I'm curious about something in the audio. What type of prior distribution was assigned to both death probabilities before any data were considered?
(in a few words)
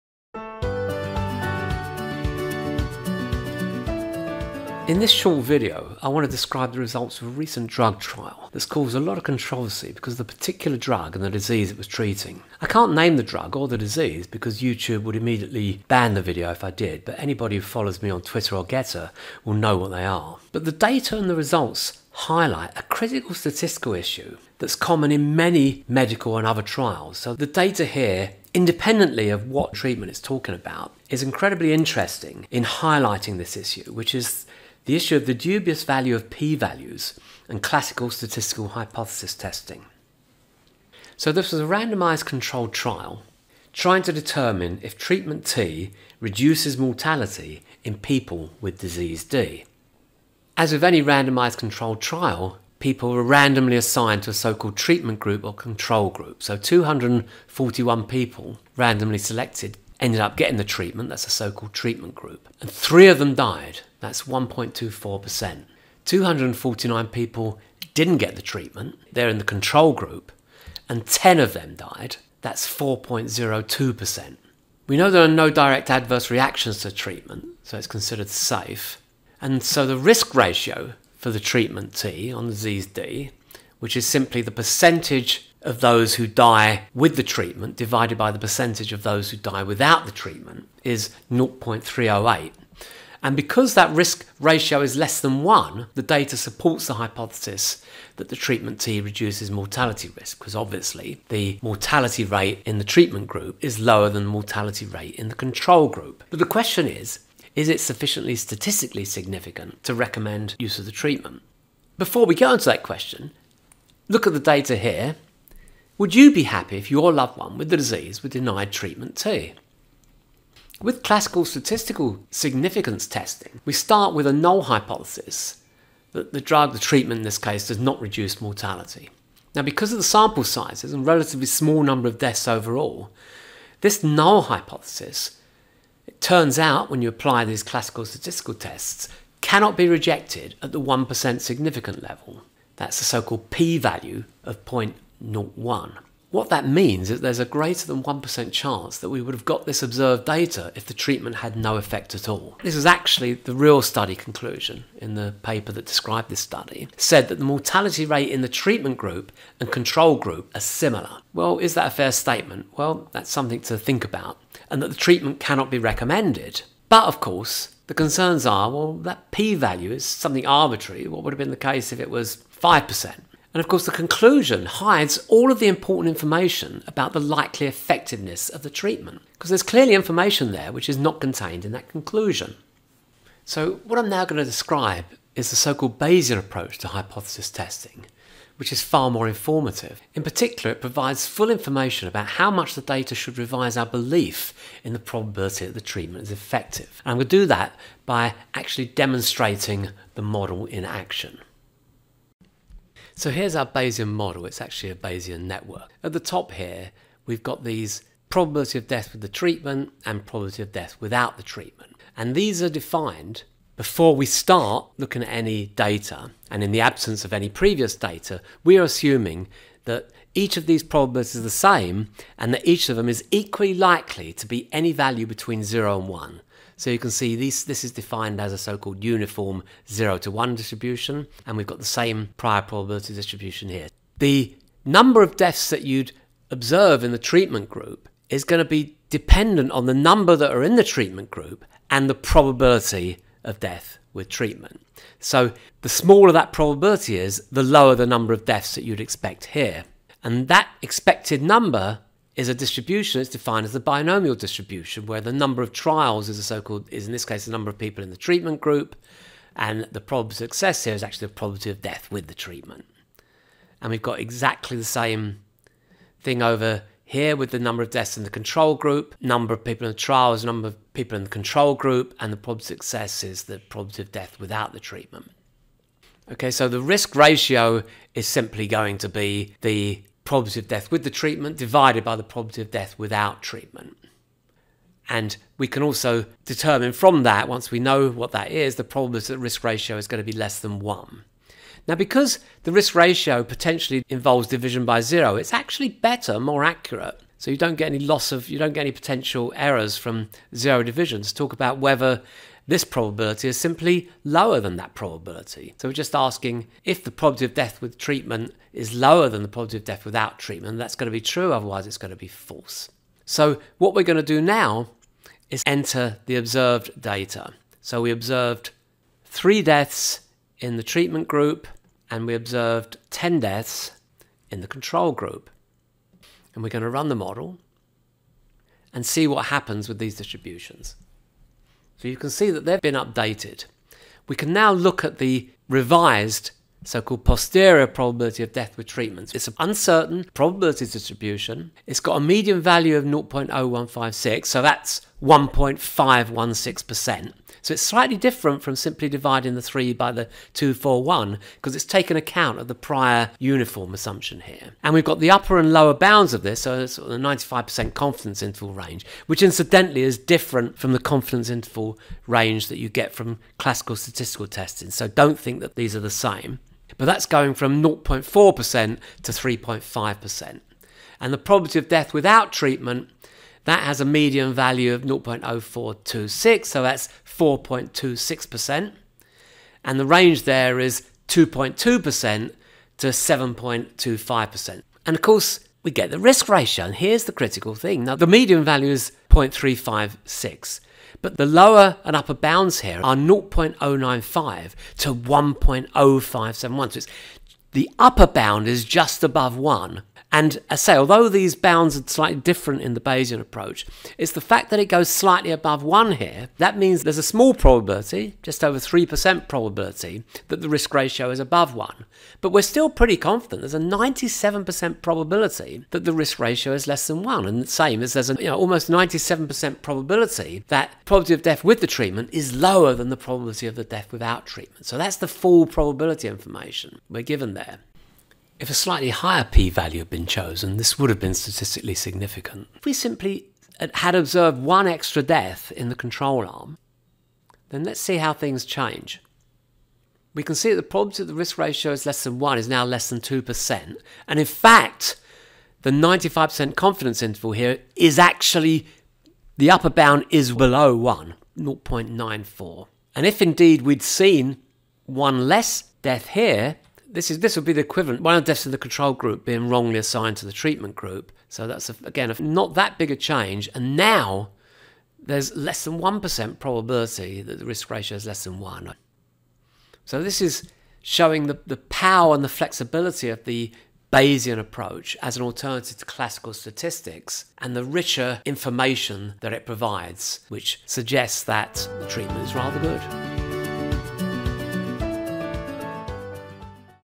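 uniform 0 to 1.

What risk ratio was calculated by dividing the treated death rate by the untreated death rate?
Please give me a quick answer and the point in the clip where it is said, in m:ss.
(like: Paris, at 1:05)
0.308, at 1:31.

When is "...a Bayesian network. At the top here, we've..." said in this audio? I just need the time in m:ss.
3:24.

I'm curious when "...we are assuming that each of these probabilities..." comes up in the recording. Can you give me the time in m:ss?
3:38.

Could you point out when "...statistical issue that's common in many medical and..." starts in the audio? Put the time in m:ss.
0:23.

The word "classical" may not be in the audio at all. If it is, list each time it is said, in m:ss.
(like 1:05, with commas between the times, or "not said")
0:37, 2:01, 2:17, 6:03, 7:56.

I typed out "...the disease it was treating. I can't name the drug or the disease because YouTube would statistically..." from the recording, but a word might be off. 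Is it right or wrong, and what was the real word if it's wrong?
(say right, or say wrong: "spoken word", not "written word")
wrong: "immediately", not "statistically".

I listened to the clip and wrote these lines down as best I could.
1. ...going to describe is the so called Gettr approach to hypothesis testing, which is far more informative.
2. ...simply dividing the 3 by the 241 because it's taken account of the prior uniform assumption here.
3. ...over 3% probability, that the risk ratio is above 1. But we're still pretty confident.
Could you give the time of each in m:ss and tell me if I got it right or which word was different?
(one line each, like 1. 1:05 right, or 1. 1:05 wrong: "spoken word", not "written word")
1. 3:04 wrong: "Bayesian", not "Gettr"
2. 5:48 right
3. 6:48 right.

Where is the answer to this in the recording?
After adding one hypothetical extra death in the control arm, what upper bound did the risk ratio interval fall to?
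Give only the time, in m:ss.
7:31.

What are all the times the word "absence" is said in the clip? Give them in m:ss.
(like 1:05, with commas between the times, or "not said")
3:36.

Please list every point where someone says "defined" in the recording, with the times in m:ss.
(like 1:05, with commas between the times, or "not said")
3:32, 3:47, 4:13.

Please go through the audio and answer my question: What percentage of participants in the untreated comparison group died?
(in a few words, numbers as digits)
4.02%.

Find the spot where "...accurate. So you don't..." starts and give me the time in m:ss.
4:56.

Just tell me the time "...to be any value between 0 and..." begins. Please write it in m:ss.
3:44.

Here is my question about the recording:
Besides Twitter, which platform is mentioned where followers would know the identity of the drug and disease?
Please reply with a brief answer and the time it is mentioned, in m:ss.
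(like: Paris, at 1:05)
Gettr, at 0:18.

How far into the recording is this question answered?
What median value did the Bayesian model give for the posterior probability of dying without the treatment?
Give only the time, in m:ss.
6:15.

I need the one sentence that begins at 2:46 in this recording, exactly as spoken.
But of course, the concerns are well, that p value is something arbitrary.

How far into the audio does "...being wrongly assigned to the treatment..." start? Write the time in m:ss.
7:39.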